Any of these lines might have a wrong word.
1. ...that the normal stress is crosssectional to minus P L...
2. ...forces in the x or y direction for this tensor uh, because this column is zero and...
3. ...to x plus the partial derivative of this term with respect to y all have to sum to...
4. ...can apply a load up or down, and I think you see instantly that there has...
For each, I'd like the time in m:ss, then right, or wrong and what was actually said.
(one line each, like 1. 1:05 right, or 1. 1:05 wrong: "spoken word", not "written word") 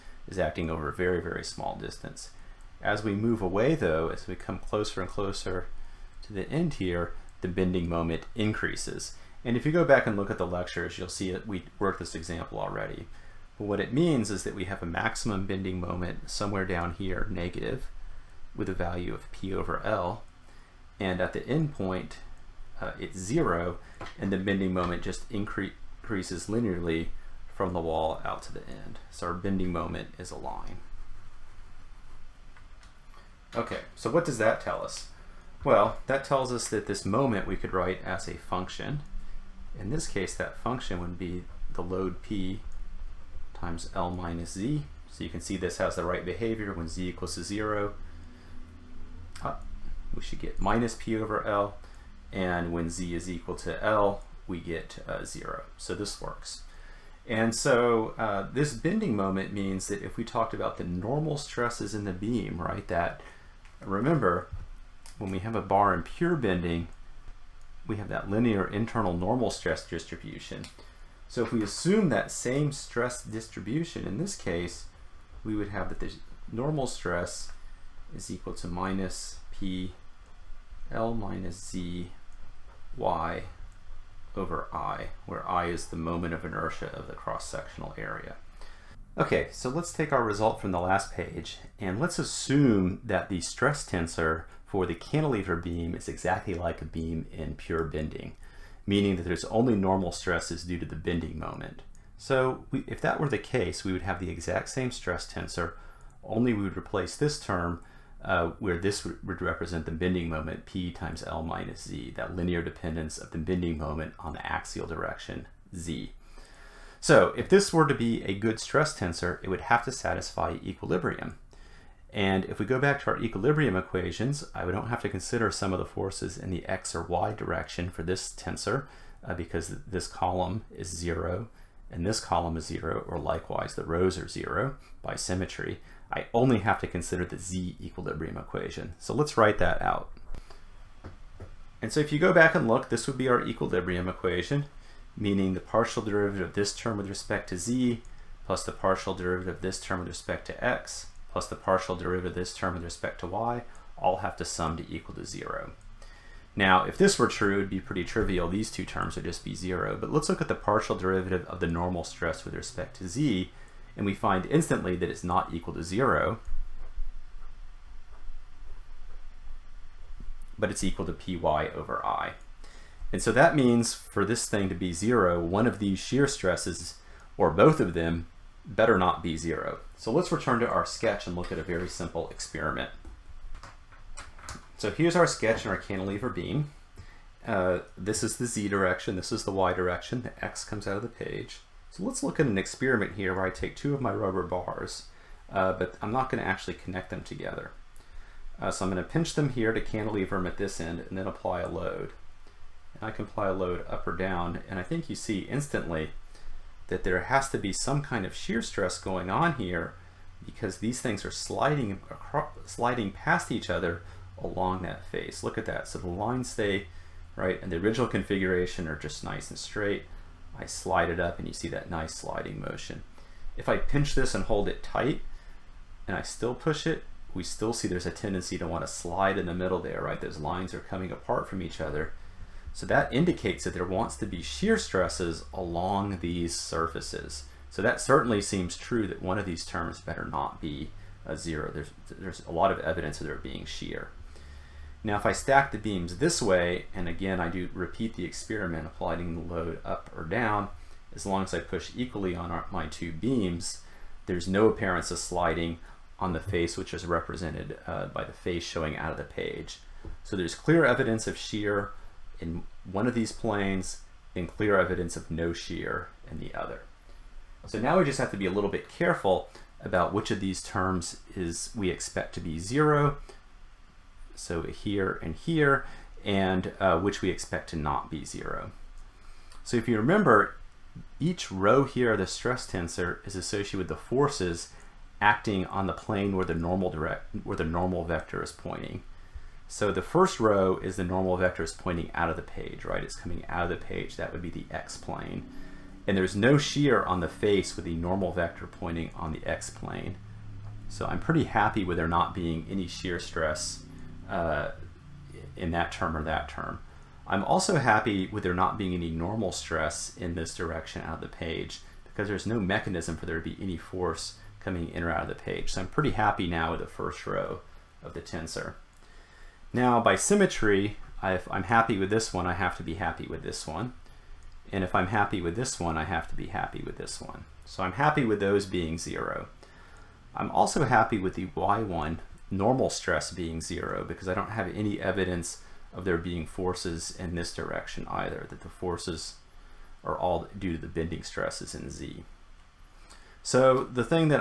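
1. 1:15 wrong: "equal", not "crosssectional"
2. 2:05 right
3. 2:30 right
4. 3:23 right.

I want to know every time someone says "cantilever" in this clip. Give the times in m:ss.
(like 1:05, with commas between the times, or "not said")
1:34, 3:05, 3:19.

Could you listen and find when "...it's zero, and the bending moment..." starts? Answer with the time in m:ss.
0:22.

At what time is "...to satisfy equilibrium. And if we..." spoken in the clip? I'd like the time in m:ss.
1:59.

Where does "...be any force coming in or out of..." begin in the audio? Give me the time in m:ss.
5:13.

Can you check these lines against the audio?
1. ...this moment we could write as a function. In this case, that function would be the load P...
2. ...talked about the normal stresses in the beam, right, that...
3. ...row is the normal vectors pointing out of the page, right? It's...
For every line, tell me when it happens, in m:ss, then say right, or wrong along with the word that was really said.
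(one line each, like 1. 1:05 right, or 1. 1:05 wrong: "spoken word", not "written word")
1. 0:36 right
2. 1:00 right
3. 4:50 right.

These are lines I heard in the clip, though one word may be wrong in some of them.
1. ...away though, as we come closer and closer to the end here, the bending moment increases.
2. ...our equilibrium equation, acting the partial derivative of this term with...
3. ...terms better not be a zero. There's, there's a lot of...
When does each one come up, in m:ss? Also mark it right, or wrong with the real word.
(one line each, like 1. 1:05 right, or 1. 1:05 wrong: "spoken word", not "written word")
1. 0:03 right
2. 2:23 wrong: "meaning", not "acting"
3. 3:59 right.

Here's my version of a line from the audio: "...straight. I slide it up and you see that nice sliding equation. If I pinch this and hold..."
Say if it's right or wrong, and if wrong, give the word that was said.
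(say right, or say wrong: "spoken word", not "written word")
wrong: "motion", not "equation".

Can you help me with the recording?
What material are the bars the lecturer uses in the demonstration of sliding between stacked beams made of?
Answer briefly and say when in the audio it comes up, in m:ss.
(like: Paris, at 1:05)
rubber, at 3:14.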